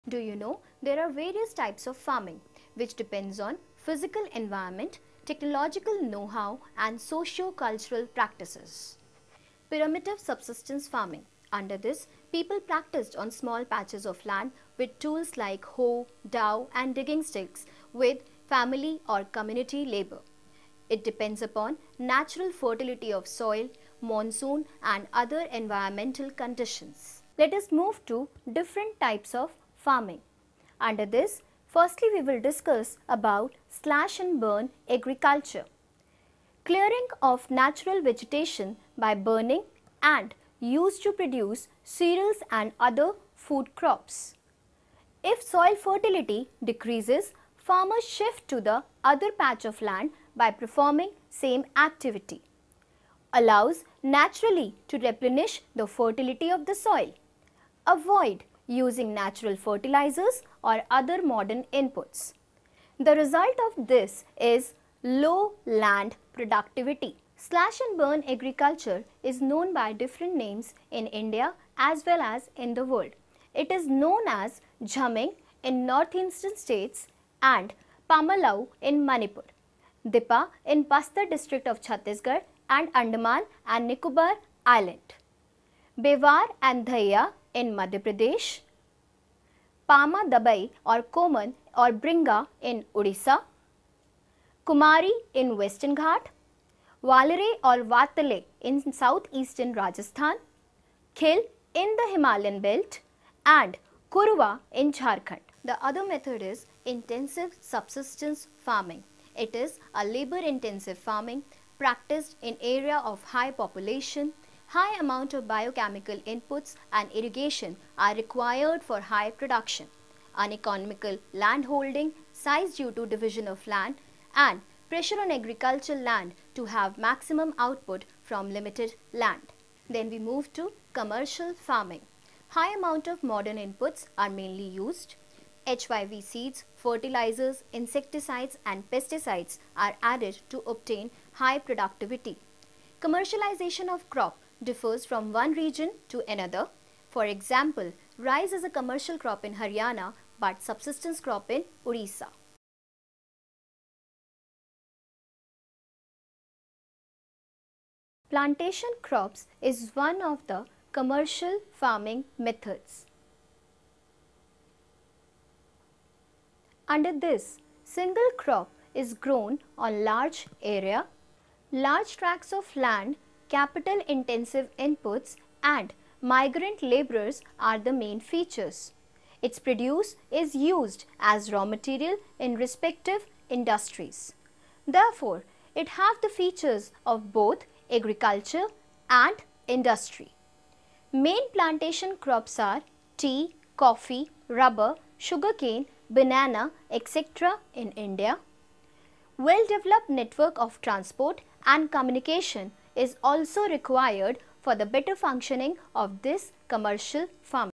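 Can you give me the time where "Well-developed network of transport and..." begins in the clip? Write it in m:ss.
3:19.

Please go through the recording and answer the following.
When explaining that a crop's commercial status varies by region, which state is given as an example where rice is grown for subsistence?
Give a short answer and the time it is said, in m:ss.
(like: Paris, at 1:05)
Orissa, at 2:31.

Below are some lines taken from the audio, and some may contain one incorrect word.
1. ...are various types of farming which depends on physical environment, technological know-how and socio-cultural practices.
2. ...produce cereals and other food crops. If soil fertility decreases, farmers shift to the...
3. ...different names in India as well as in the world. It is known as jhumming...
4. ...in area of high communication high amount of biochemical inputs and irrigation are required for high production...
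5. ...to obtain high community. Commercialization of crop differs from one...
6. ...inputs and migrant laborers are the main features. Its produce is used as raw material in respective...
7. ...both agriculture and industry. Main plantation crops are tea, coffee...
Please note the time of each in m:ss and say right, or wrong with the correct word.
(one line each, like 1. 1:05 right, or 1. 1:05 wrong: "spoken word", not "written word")
1. 0:01 right
2. 0:41 right
3. 1:09 right
4. 1:52 wrong: "population", not "communication"
5. 2:20 wrong: "productivity", not "community"
6. 2:54 right
7. 3:07 right.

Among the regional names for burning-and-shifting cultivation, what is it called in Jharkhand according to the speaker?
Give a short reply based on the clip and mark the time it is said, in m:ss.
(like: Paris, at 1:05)
Kurwa, at 1:44.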